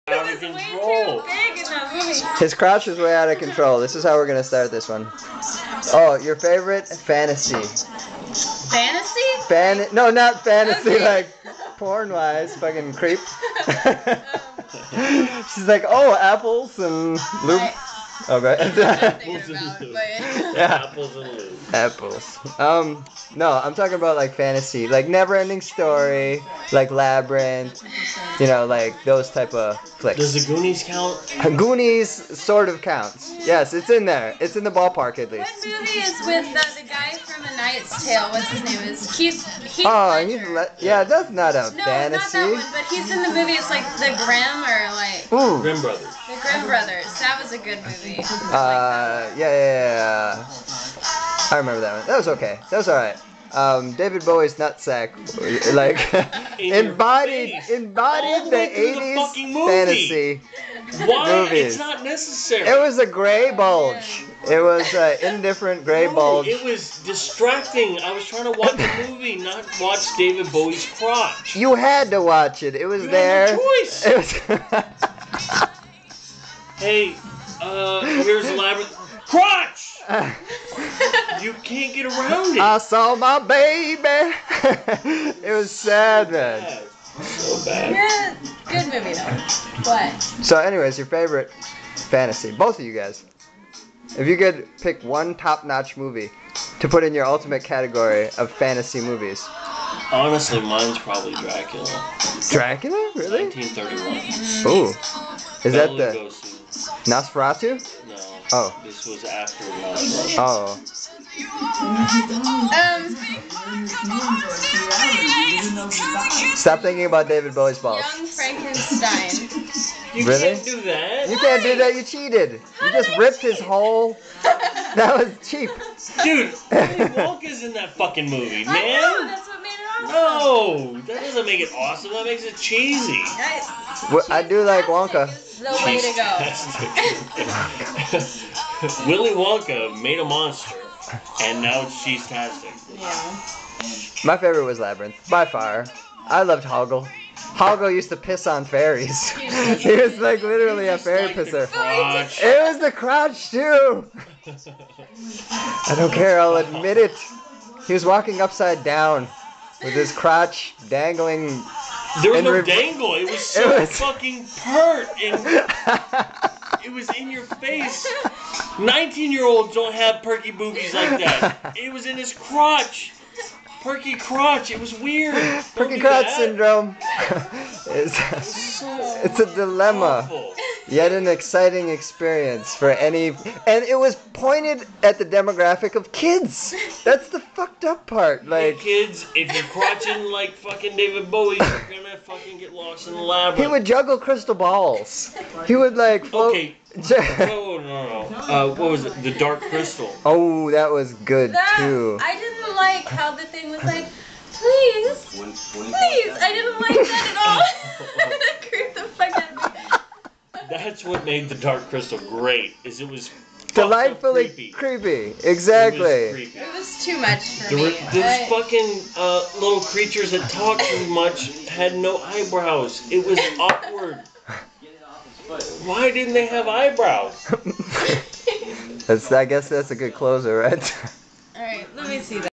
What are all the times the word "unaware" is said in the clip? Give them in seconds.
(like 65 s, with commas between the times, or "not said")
not said.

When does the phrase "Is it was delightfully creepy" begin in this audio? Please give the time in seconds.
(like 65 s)
212 s.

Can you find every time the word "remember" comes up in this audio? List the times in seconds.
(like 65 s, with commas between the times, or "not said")
51 s.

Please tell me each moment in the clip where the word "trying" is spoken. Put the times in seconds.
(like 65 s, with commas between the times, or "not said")
68 s.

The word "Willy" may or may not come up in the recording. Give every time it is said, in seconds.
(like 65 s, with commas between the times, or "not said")
126 s, 139 s.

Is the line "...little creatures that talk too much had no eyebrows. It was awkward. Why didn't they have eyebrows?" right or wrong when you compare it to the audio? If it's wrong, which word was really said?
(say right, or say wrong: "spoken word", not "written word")
right.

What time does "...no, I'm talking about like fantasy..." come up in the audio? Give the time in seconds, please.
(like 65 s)
23 s.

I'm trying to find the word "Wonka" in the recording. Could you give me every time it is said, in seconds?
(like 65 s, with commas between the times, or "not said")
134 s, 139 s.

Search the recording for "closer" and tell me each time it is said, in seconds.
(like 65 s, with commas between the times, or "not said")
230 s.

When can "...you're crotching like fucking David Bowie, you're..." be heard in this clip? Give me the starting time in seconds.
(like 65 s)
189 s.